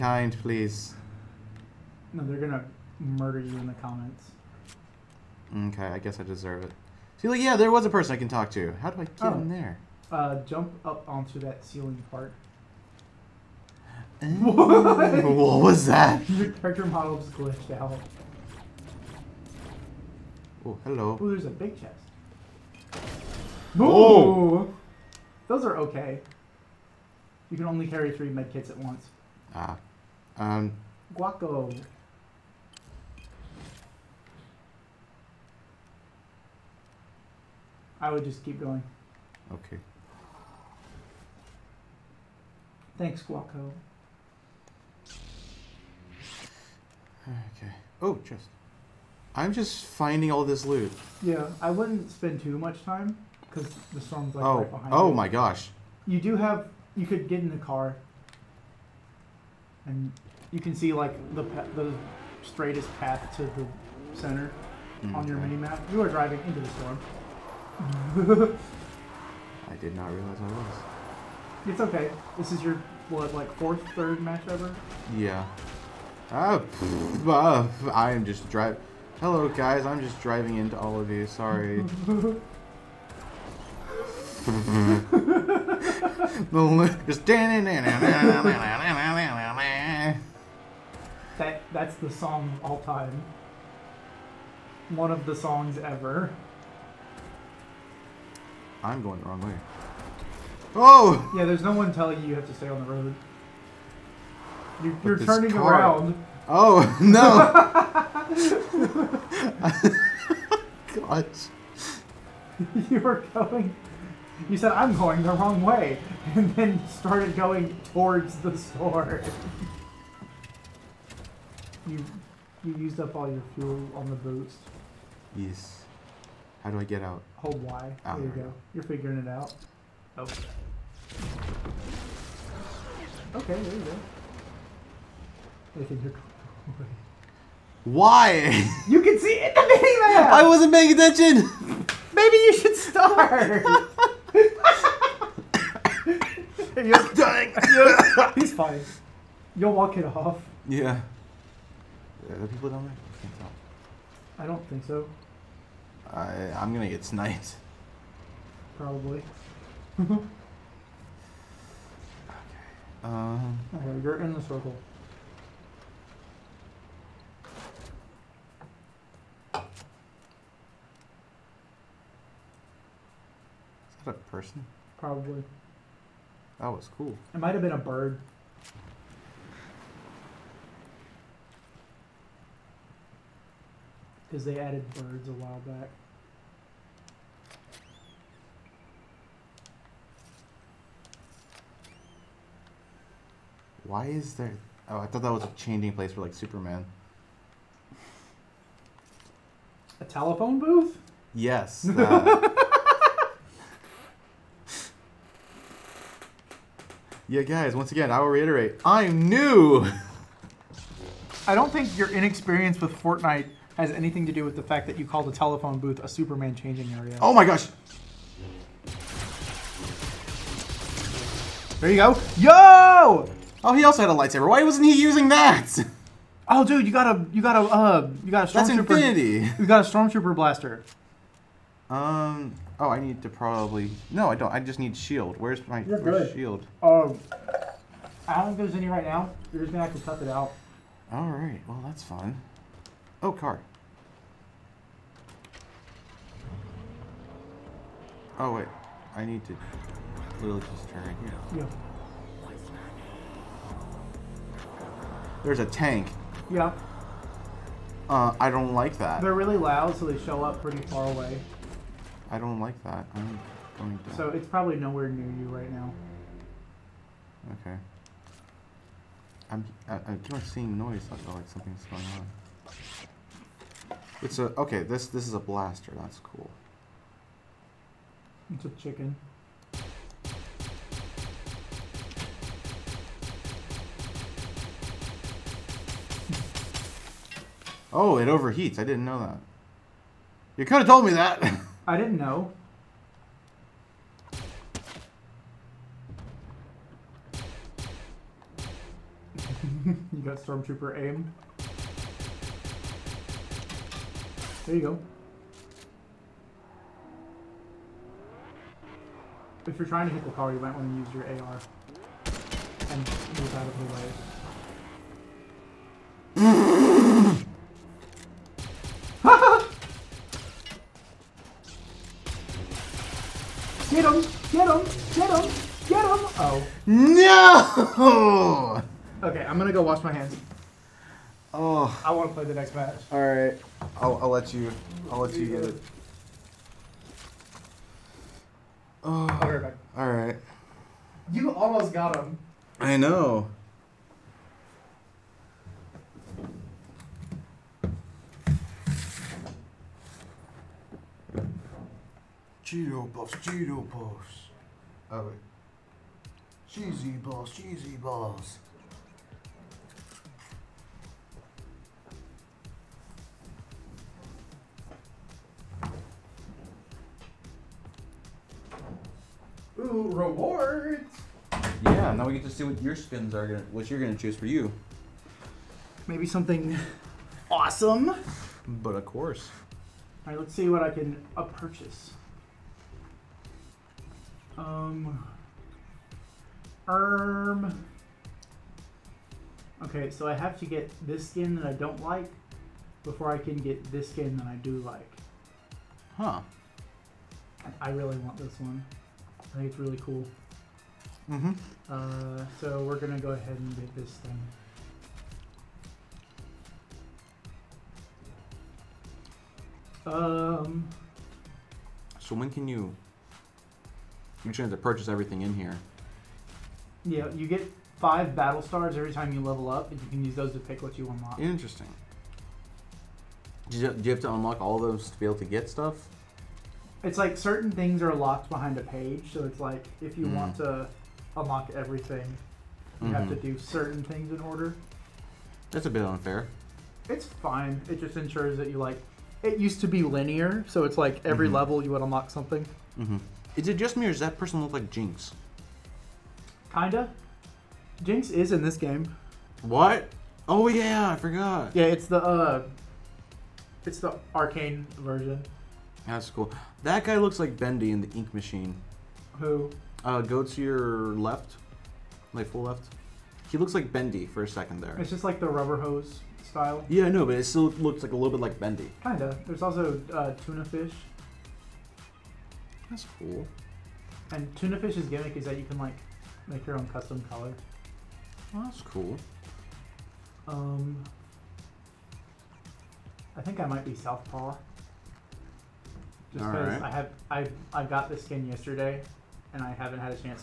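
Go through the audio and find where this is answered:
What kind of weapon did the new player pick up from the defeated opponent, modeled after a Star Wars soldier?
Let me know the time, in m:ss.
3:49.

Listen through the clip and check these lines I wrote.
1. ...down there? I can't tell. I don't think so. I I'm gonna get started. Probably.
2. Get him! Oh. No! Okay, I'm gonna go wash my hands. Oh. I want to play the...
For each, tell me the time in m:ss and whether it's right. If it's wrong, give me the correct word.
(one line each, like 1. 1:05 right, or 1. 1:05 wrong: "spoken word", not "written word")
1. 2:32 wrong: "sniped", not "started"
2. 5:25 right.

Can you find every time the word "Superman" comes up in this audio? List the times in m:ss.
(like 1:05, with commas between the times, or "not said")
3:16, 3:36.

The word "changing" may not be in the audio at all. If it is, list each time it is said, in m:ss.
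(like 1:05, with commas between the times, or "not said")
3:15, 3:36.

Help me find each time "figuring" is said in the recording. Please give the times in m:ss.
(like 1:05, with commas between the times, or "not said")
2:08.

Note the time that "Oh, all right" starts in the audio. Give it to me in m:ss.
5:39.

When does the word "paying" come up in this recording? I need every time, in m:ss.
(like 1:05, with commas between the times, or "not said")
2:20.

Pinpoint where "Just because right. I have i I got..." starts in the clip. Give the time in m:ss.
8:06.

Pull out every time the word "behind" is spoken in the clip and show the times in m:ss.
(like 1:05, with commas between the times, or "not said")
0:54, 7:08.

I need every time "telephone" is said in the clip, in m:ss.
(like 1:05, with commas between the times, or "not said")
3:20, 3:35.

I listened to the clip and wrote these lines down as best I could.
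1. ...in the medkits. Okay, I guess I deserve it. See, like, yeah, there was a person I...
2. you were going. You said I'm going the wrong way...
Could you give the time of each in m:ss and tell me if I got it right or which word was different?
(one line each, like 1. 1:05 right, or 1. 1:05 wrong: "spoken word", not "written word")
1. 0:03 wrong: "comments", not "medkits"
2. 1:52 right.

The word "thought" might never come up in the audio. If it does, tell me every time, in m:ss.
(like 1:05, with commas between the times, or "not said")
3:15.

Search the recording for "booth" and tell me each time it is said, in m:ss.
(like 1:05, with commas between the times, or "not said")
3:20, 3:35.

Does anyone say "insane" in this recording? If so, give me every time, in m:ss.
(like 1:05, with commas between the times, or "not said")
not said.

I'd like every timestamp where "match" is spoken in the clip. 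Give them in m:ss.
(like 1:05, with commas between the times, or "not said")
1:14, 5:32.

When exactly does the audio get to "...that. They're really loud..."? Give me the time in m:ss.
4:18.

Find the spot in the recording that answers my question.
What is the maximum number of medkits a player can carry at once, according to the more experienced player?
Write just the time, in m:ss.
0:28.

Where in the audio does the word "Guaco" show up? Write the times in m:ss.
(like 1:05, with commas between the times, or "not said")
0:31, 0:43.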